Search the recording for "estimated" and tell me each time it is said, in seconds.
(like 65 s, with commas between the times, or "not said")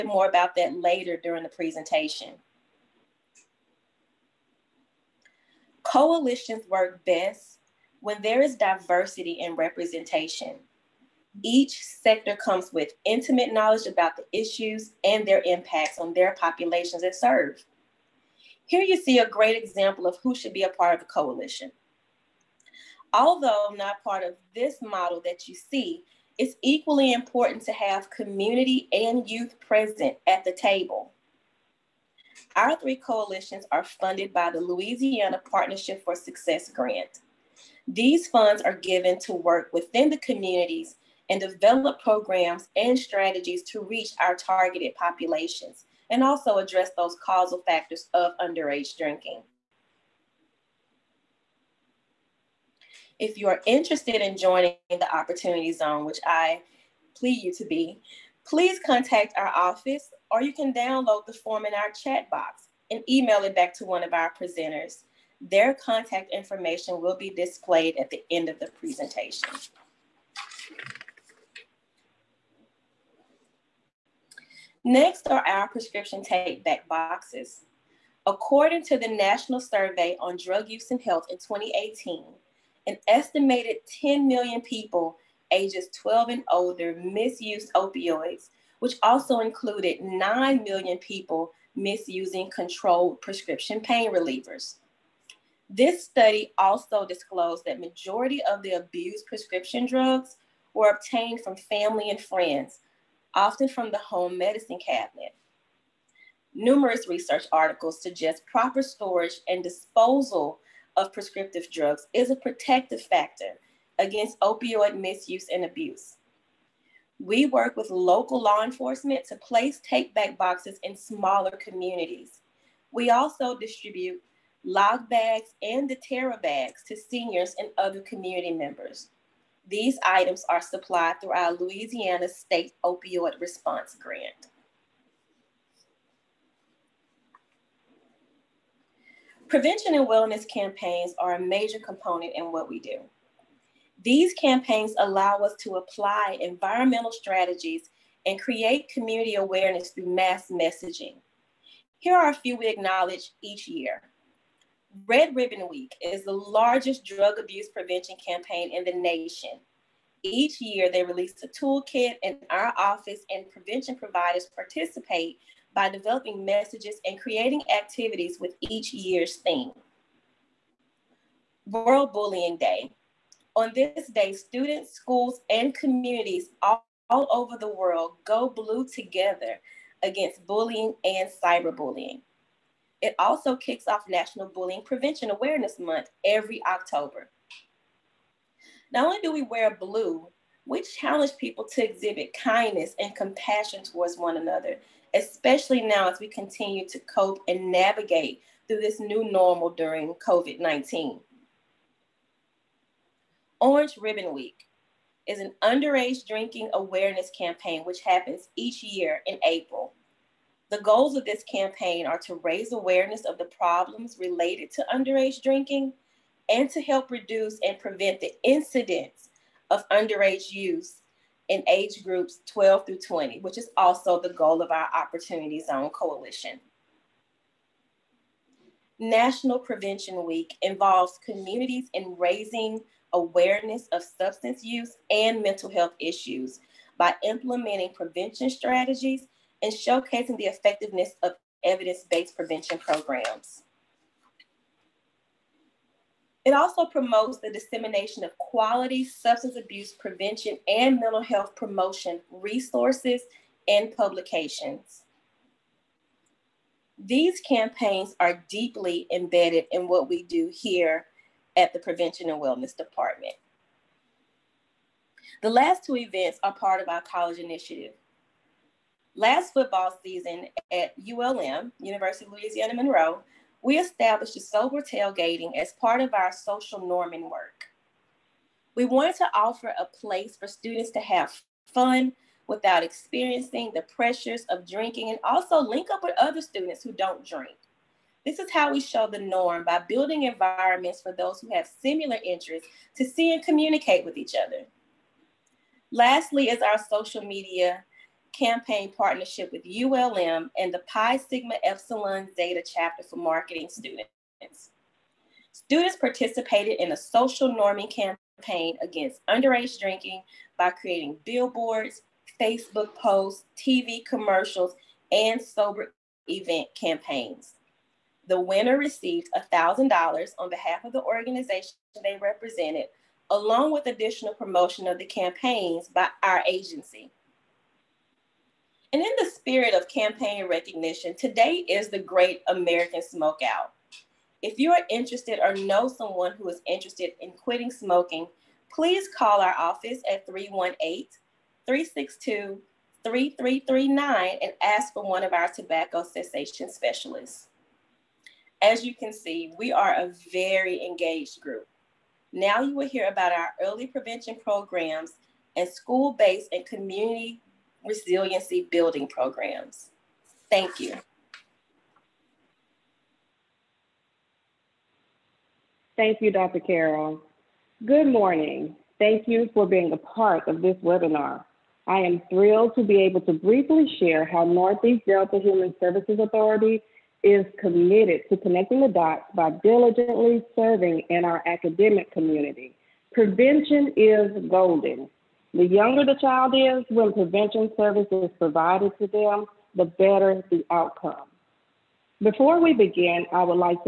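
83 s.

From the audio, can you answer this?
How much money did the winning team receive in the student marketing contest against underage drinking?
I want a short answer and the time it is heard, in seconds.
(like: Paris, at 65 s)
$1,000, at 319 s.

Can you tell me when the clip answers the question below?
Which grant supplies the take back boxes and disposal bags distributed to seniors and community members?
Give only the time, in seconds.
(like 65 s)
131 s.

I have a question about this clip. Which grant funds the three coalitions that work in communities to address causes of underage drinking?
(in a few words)
Louisiana Partnership for Success Grant.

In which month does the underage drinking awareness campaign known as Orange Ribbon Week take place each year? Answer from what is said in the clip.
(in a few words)
April.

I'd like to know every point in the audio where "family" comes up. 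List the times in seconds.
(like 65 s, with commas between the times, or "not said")
101 s.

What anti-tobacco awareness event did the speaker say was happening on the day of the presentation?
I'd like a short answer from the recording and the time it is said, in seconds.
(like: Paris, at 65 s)
Great American Smokeout, at 331 s.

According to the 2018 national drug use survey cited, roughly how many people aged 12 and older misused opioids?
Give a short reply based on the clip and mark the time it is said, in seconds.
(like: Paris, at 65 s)
10 million, at 84 s.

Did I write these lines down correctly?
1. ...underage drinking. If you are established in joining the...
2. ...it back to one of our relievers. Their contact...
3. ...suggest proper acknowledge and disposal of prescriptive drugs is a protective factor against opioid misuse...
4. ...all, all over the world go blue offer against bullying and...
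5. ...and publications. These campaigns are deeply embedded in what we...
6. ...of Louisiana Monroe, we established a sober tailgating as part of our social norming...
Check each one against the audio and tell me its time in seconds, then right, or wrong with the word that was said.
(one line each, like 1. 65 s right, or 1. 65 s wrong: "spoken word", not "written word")
1. 48 s wrong: "interested", not "established"
2. 63 s wrong: "presenters", not "relievers"
3. 108 s wrong: "storage", not "acknowledge"
4. 176 s wrong: "together", not "offer"
5. 253 s right
6. 272 s right.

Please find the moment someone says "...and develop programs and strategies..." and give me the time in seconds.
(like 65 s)
41 s.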